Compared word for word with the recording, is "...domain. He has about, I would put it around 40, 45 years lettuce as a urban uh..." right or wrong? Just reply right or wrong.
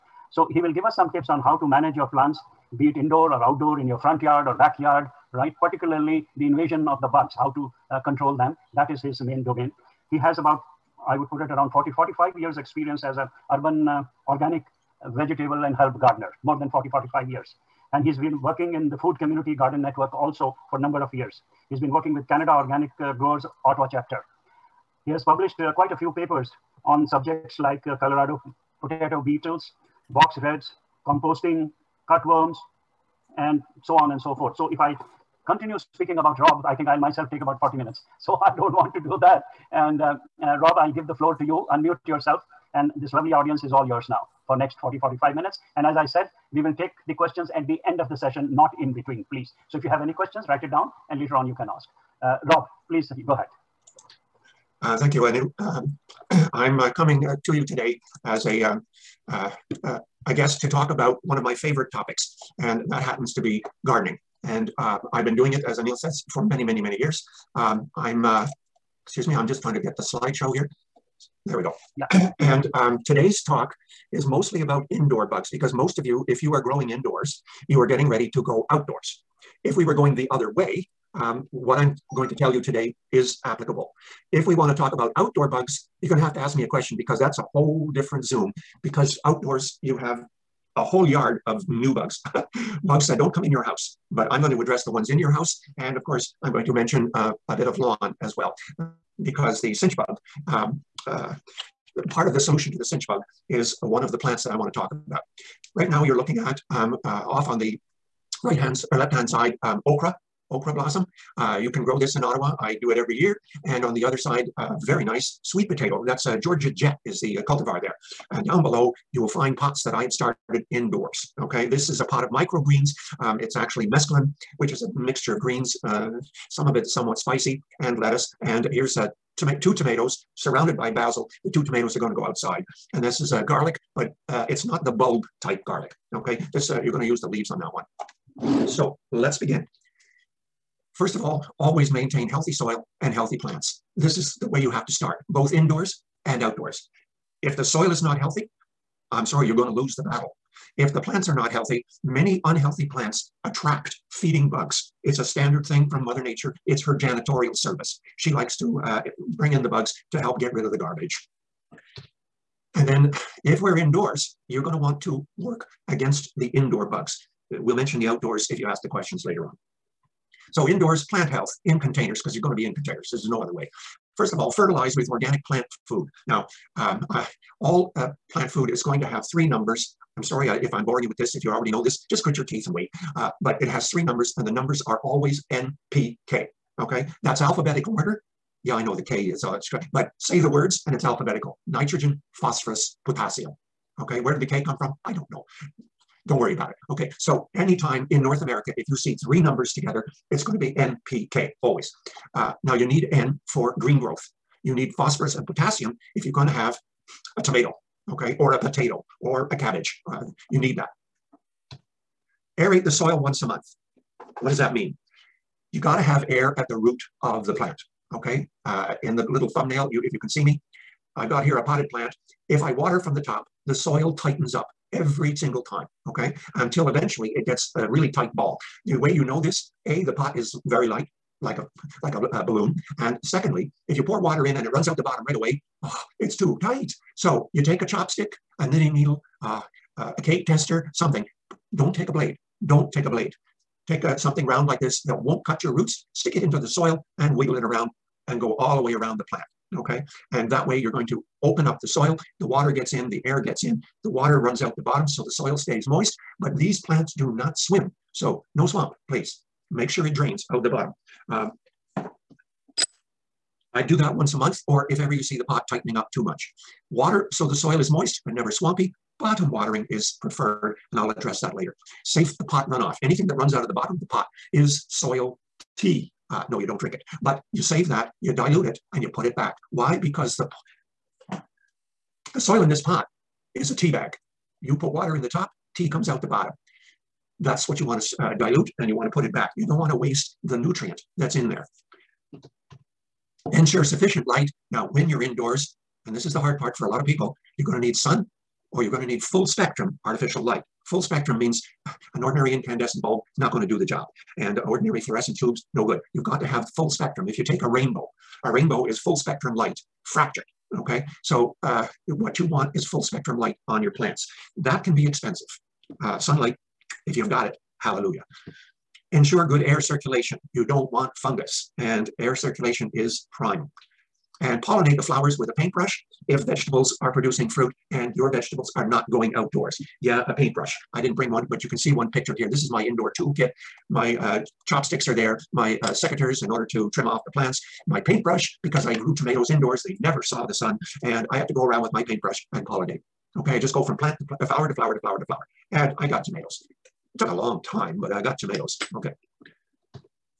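wrong.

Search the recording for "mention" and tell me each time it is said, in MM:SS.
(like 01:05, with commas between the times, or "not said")
01:36, 02:47.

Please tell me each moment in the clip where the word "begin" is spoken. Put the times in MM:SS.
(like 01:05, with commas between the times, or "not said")
02:19.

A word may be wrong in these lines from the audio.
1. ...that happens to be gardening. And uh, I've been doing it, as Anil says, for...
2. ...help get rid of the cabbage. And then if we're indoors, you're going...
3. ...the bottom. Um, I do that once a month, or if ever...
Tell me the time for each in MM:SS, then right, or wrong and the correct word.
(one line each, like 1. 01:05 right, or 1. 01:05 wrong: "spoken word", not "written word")
1. 01:02 right
2. 02:40 wrong: "garbage", not "cabbage"
3. 04:20 right.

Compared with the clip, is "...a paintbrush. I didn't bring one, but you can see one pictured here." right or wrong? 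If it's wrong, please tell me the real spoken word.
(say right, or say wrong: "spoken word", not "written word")
right.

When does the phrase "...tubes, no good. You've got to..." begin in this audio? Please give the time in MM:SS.
05:05.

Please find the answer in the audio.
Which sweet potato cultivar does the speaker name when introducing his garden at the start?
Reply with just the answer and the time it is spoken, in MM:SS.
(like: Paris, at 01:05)
Georgia Jet, at 01:56.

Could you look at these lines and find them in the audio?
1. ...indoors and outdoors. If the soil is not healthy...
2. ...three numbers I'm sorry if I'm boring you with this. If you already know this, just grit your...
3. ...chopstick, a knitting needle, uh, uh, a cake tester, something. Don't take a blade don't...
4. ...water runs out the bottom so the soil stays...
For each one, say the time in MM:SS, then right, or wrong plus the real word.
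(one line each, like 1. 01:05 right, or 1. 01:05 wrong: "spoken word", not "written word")
1. 02:25 right
2. 02:59 right
3. 03:57 right
4. 04:14 right.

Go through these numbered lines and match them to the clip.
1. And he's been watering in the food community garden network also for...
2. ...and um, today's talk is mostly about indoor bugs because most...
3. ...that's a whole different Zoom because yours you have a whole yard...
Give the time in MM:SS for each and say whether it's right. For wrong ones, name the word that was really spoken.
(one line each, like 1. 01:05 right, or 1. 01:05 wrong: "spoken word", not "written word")
1. 00:17 wrong: "working", not "watering"
2. 01:12 right
3. 01:27 wrong: "outdoors", not "yours".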